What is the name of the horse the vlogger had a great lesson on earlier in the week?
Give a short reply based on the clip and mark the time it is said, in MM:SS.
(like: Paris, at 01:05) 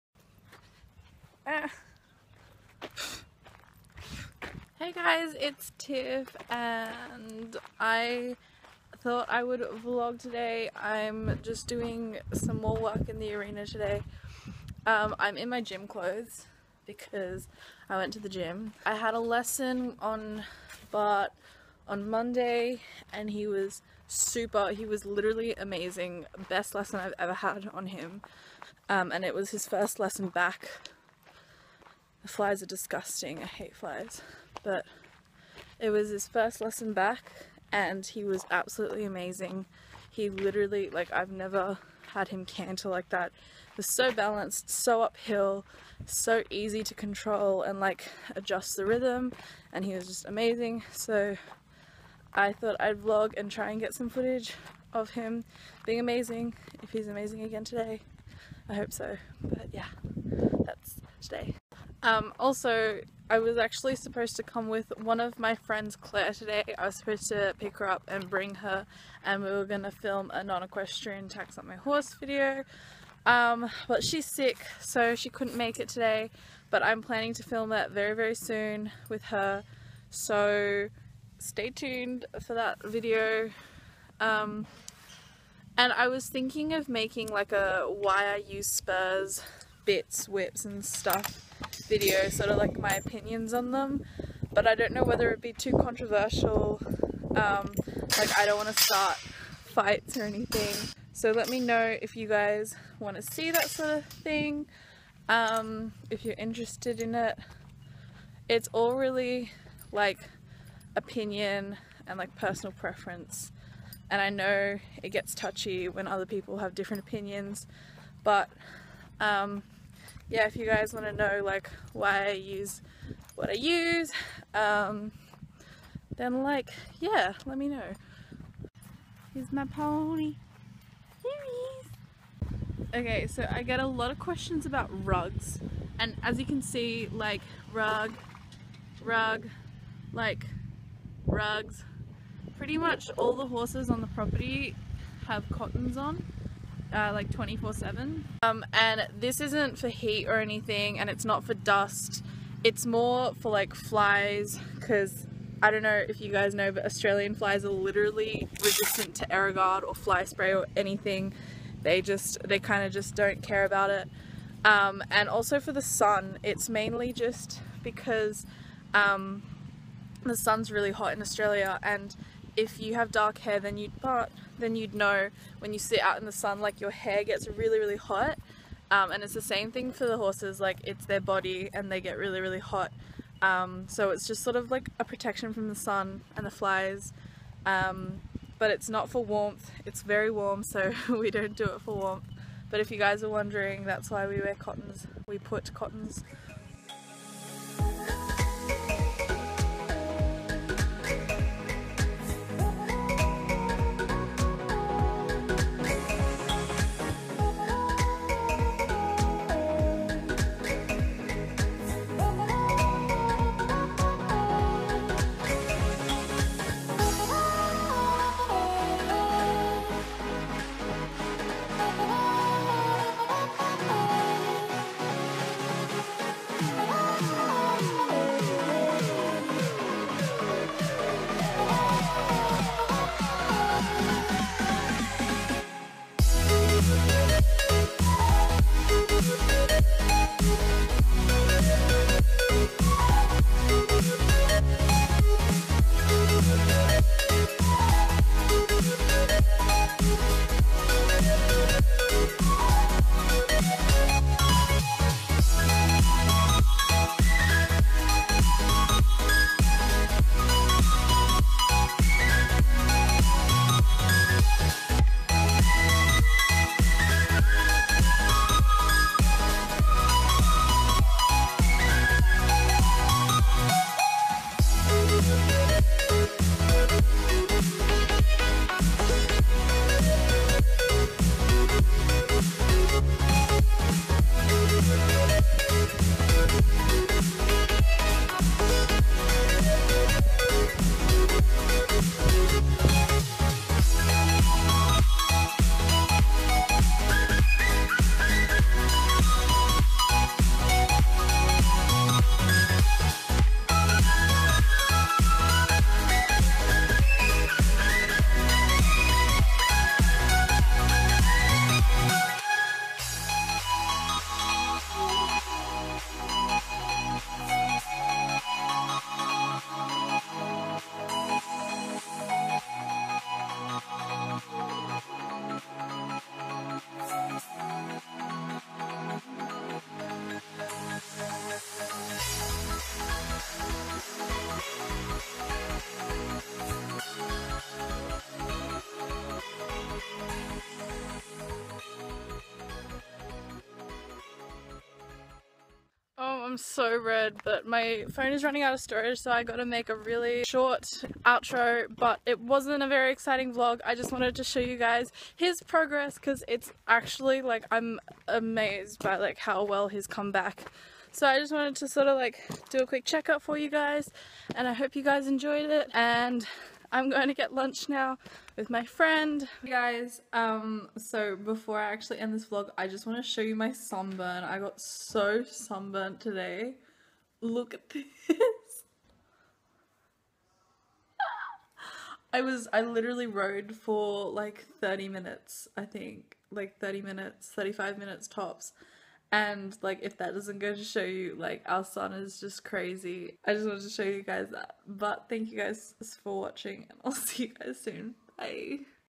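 Bart, at 00:20.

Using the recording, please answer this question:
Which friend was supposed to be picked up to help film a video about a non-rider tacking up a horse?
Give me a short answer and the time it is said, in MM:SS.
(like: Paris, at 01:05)
Claire, at 01:05.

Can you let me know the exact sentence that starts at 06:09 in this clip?
Hey guys, um, so before I actually end this vlog, I just want to show you my sunburn.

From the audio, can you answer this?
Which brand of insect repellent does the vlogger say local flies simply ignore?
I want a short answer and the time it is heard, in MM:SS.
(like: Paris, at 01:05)
Aerogard, at 02:39.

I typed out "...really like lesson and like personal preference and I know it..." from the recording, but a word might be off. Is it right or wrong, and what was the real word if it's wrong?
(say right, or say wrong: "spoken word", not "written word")
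wrong: "opinion", not "lesson".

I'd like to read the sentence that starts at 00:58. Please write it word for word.
I hope so, but yeah, that's today.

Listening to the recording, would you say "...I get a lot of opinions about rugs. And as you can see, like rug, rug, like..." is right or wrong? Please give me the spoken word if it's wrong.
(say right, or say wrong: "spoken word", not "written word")
wrong: "questions", not "opinions".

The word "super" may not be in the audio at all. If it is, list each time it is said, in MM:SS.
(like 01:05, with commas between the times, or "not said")
00:24.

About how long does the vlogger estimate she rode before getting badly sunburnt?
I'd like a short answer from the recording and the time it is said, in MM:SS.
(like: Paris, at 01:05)
35 minutes, at 06:27.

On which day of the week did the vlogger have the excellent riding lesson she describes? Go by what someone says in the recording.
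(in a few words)
Monday.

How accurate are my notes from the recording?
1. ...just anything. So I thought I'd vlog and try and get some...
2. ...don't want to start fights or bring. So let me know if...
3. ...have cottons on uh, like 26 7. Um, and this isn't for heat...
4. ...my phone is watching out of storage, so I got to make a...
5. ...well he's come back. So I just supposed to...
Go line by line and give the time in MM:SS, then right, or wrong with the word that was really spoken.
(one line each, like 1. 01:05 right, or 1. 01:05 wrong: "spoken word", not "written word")
1. 00:50 wrong: "amazing", not "anything"
2. 01:38 wrong: "anything", not "bring"
3. 02:25 wrong: "24", not "26"
4. 05:47 wrong: "running", not "watching"
5. 05:59 wrong: "wanted", not "supposed".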